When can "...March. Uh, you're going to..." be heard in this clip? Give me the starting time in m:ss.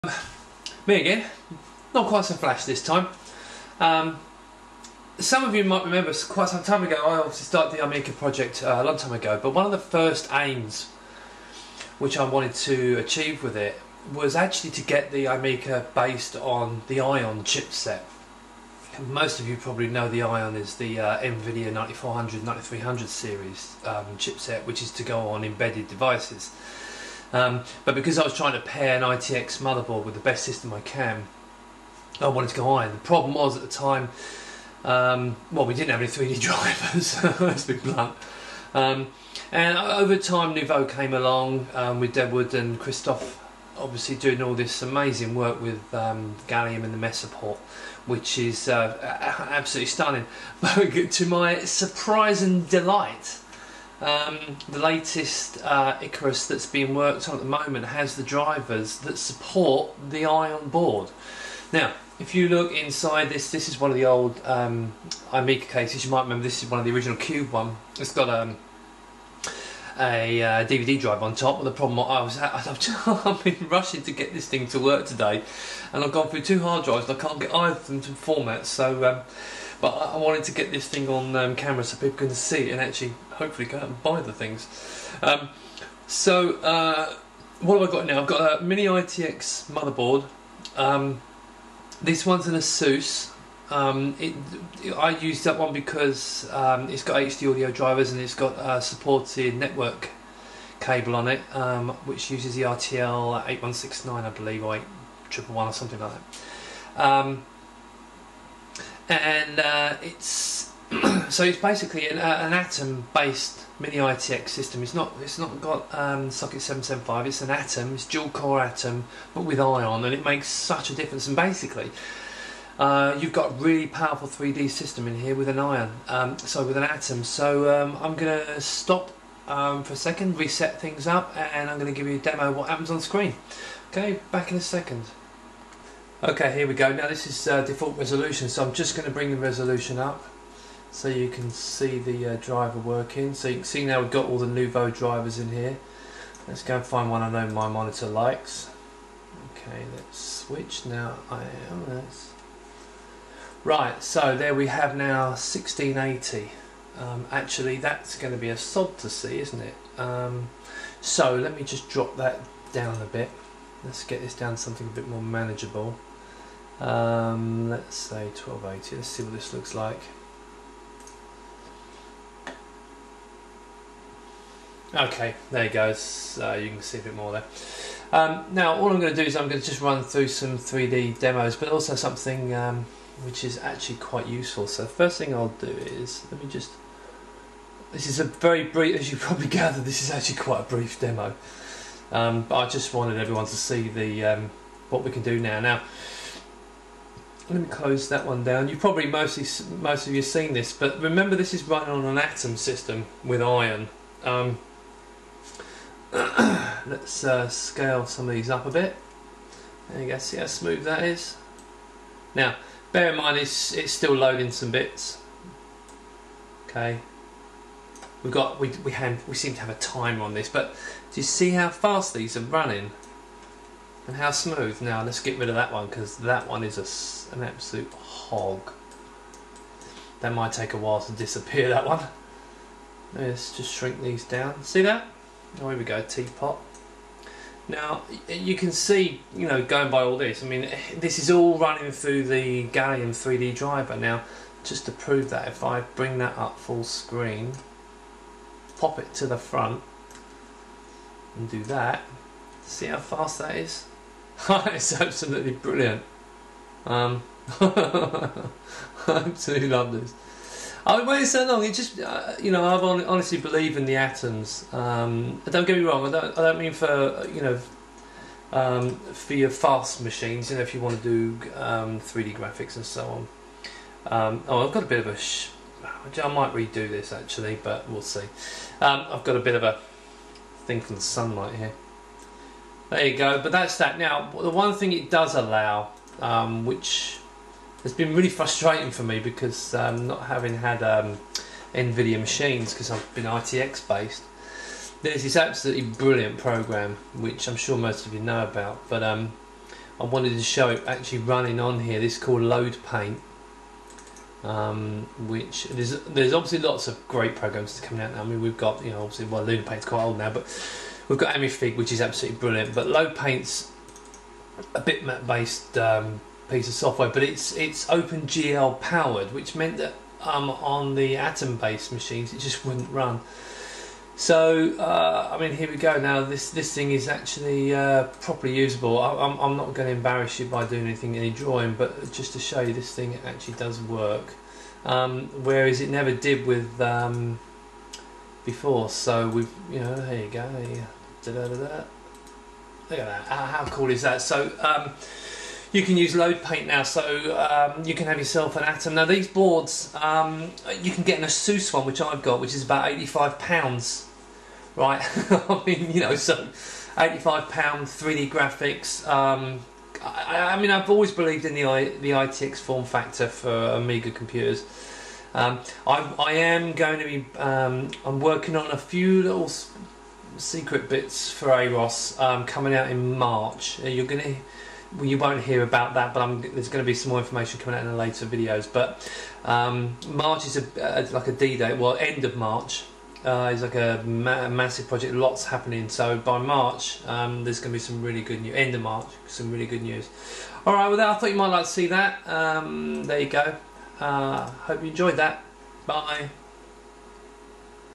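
6:13.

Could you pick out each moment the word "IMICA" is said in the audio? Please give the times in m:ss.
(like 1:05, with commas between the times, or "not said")
0:07, 0:15.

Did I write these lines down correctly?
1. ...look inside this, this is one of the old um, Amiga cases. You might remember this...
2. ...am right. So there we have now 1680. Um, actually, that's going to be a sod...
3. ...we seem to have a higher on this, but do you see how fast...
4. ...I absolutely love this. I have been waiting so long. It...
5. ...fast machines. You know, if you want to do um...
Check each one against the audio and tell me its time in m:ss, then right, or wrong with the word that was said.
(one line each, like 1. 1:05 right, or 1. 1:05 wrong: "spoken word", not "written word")
1. 1:02 right
2. 2:31 right
3. 3:39 wrong: "timer", not "higher"
4. 4:17 right
5. 4:29 right.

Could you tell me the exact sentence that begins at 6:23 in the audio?
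Uh, is like a ma massive project, lots happening.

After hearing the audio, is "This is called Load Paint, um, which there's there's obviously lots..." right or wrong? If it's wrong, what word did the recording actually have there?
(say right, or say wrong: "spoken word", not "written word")
right.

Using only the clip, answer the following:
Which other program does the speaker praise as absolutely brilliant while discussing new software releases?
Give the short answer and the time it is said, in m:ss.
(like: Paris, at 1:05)
Amifig, at 5:11.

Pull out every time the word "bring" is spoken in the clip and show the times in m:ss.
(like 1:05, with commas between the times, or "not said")
2:19, 4:05.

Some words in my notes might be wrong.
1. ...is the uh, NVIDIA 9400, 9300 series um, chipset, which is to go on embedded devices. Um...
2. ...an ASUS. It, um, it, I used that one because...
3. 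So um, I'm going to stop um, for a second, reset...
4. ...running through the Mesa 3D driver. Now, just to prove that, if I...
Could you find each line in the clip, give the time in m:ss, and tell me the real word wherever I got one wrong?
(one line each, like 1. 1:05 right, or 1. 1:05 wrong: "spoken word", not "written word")
1. 0:20 right
2. 1:32 right
3. 2:07 right
4. 4:01 wrong: "Gallium", not "Mesa".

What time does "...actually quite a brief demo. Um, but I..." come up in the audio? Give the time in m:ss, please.
3:10.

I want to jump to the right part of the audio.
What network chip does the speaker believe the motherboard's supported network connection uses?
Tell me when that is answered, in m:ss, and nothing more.
1:42.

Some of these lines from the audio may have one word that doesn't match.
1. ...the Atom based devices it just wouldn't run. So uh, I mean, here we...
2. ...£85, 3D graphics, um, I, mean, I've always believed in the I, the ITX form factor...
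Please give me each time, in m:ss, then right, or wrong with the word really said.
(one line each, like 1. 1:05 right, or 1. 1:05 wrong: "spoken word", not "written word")
1. 5:20 wrong: "machines", not "devices"
2. 5:56 right.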